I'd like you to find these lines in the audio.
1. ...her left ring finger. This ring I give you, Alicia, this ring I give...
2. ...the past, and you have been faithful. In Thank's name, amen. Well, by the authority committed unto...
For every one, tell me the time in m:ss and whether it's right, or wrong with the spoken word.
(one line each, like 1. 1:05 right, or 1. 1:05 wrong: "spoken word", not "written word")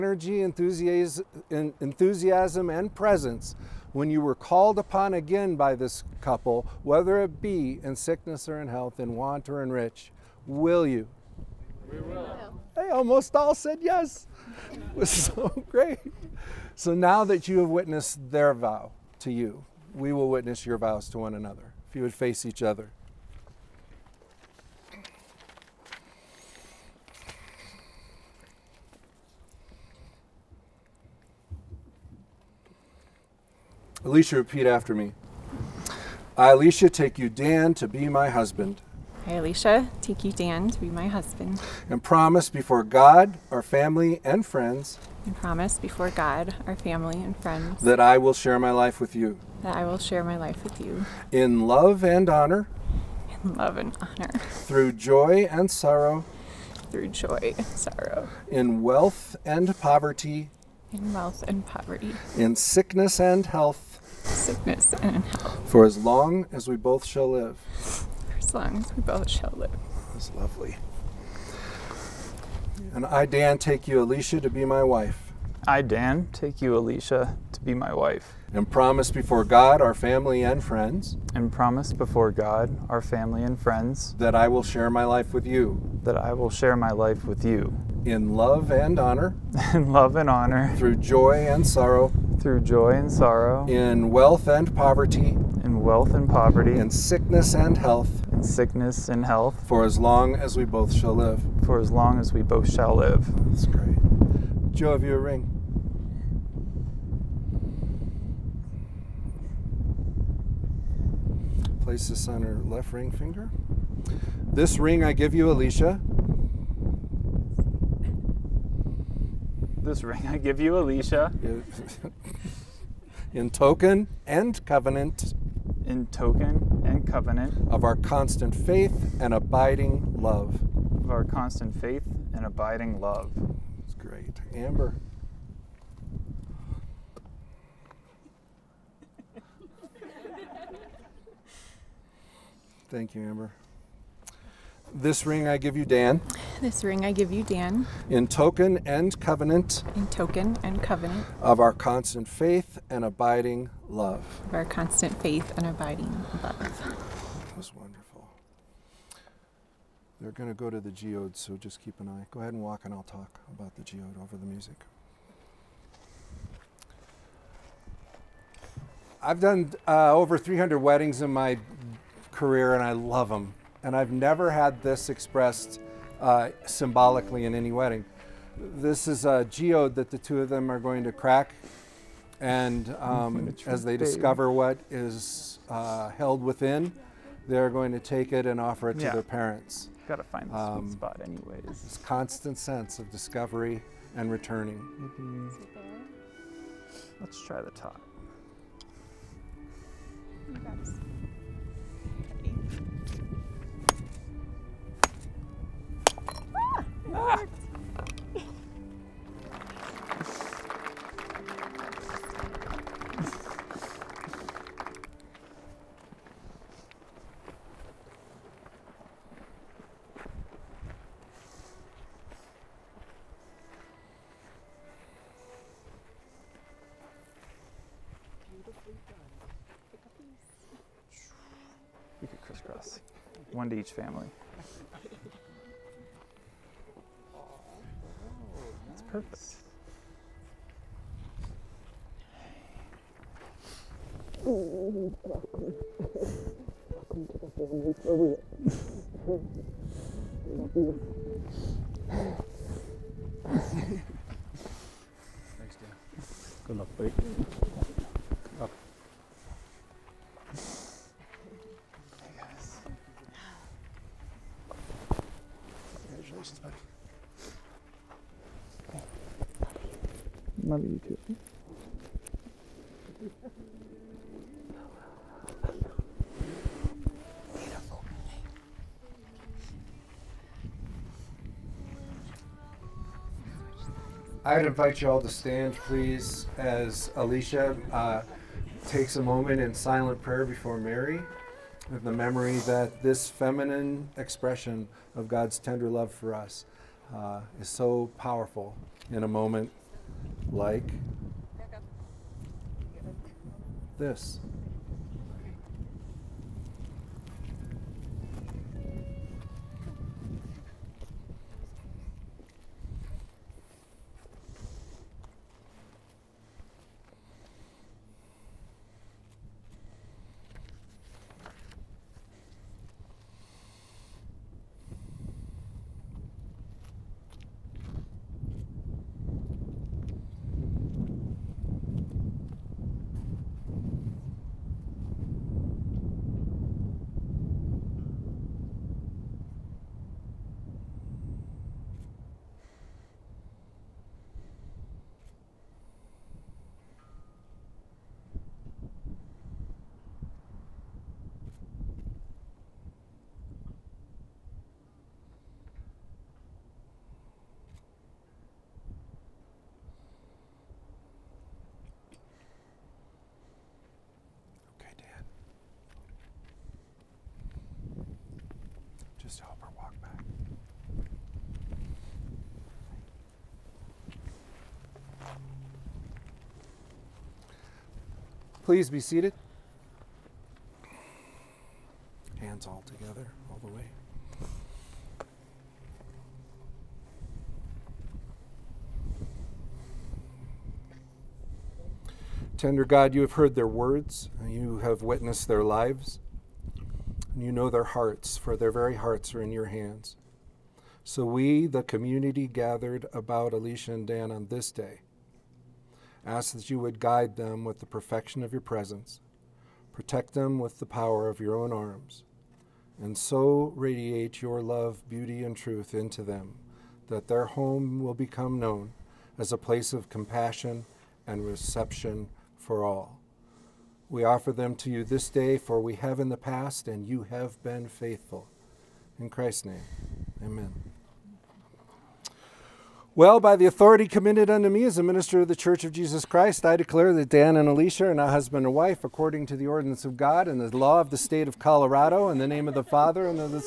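1. 1:52 right
2. 7:06 wrong: "Christ", not "Thank".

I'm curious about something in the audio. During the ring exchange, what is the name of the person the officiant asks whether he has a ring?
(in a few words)
Joe.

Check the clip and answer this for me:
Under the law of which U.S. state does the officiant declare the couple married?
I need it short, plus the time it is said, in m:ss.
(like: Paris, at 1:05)
Colorado, at 7:21.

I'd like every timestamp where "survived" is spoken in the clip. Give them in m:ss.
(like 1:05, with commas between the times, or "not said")
not said.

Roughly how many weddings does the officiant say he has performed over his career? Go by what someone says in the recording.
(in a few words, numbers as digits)
Over 300.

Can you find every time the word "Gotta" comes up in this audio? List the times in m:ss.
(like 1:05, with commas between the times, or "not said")
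3:10.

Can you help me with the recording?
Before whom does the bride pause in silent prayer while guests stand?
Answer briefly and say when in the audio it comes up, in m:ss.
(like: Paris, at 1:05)
Mary, at 4:50.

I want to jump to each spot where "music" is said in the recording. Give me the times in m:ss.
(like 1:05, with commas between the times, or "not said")
2:44.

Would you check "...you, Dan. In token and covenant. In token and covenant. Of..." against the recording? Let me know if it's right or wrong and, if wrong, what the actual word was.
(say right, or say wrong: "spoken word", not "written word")
right.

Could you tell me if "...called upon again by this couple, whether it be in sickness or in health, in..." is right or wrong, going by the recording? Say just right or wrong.
right.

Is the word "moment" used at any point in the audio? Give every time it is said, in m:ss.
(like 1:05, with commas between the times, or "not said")
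4:49, 4:59.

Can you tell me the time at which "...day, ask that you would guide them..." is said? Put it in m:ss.
6:44.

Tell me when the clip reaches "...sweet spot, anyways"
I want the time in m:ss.
3:10.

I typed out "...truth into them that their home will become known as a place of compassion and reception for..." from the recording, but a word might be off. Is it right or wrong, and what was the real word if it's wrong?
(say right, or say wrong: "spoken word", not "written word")
right.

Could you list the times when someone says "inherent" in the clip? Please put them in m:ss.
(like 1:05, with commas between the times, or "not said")
not said.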